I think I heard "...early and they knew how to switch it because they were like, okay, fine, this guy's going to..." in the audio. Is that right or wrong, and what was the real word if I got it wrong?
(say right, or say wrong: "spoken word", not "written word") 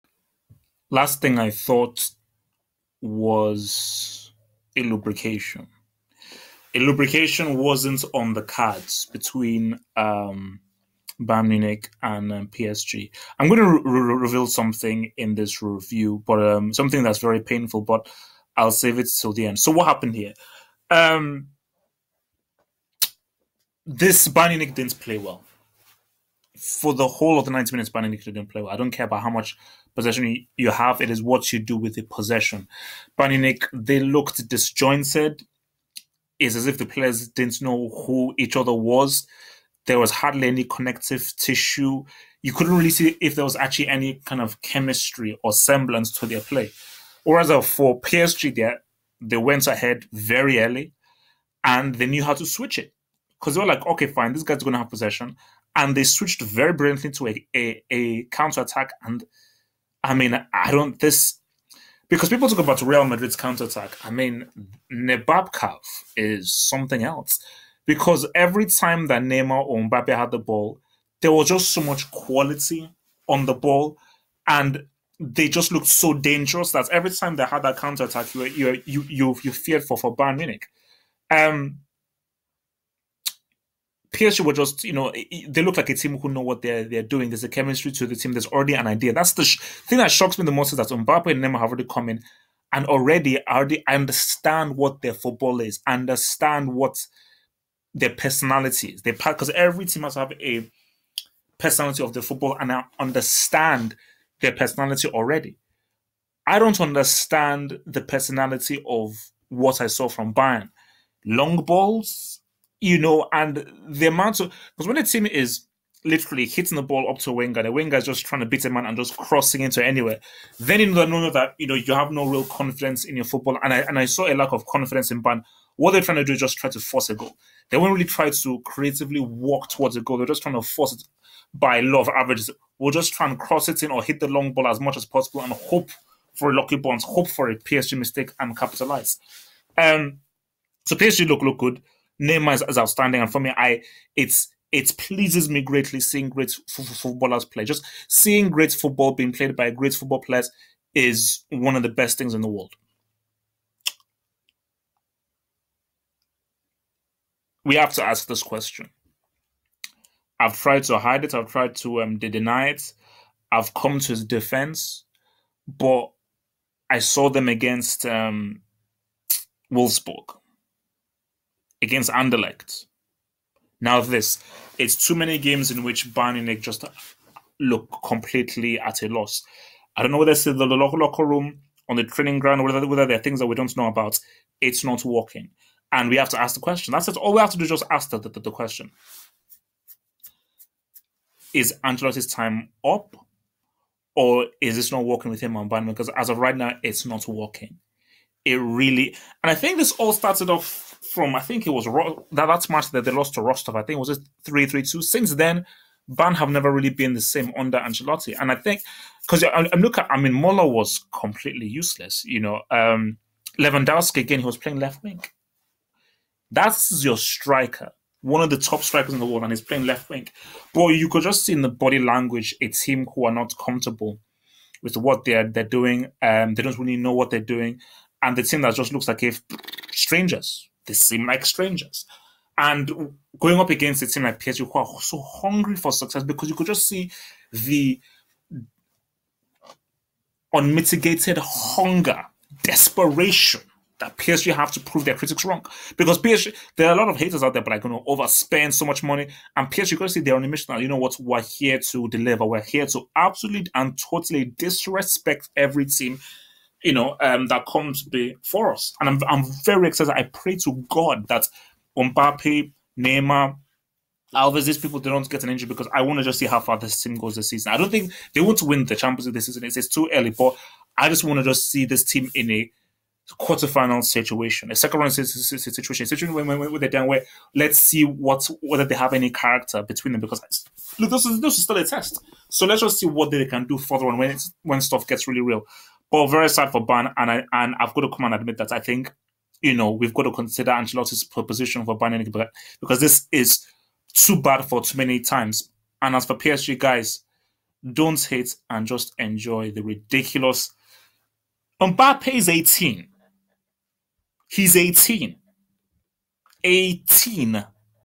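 right.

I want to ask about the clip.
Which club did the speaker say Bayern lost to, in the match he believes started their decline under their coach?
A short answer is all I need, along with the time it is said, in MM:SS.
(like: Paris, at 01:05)
Rostov, at 03:23.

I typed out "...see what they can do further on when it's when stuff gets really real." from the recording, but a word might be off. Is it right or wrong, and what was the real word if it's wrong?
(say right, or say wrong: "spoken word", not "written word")
right.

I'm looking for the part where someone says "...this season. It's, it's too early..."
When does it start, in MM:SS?
04:29.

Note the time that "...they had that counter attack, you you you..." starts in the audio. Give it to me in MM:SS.
01:17.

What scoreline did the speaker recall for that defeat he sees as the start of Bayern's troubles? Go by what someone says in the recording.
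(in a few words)
3-2.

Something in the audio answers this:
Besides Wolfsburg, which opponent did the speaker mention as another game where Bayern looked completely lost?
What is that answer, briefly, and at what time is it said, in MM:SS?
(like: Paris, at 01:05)
Anderlecht, at 02:52.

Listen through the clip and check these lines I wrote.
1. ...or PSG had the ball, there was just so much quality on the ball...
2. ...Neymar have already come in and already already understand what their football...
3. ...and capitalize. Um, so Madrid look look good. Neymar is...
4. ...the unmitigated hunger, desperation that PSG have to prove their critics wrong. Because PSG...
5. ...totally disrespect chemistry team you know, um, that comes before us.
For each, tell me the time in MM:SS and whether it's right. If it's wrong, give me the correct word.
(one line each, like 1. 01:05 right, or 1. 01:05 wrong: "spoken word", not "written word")
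1. 01:09 wrong: "Mbappe", not "PSG"
2. 01:31 right
3. 02:18 wrong: "PSG", not "Madrid"
4. 03:57 right
5. 04:13 wrong: "every", not "chemistry".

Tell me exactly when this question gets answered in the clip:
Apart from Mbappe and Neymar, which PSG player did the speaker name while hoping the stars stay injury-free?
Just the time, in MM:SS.
04:24.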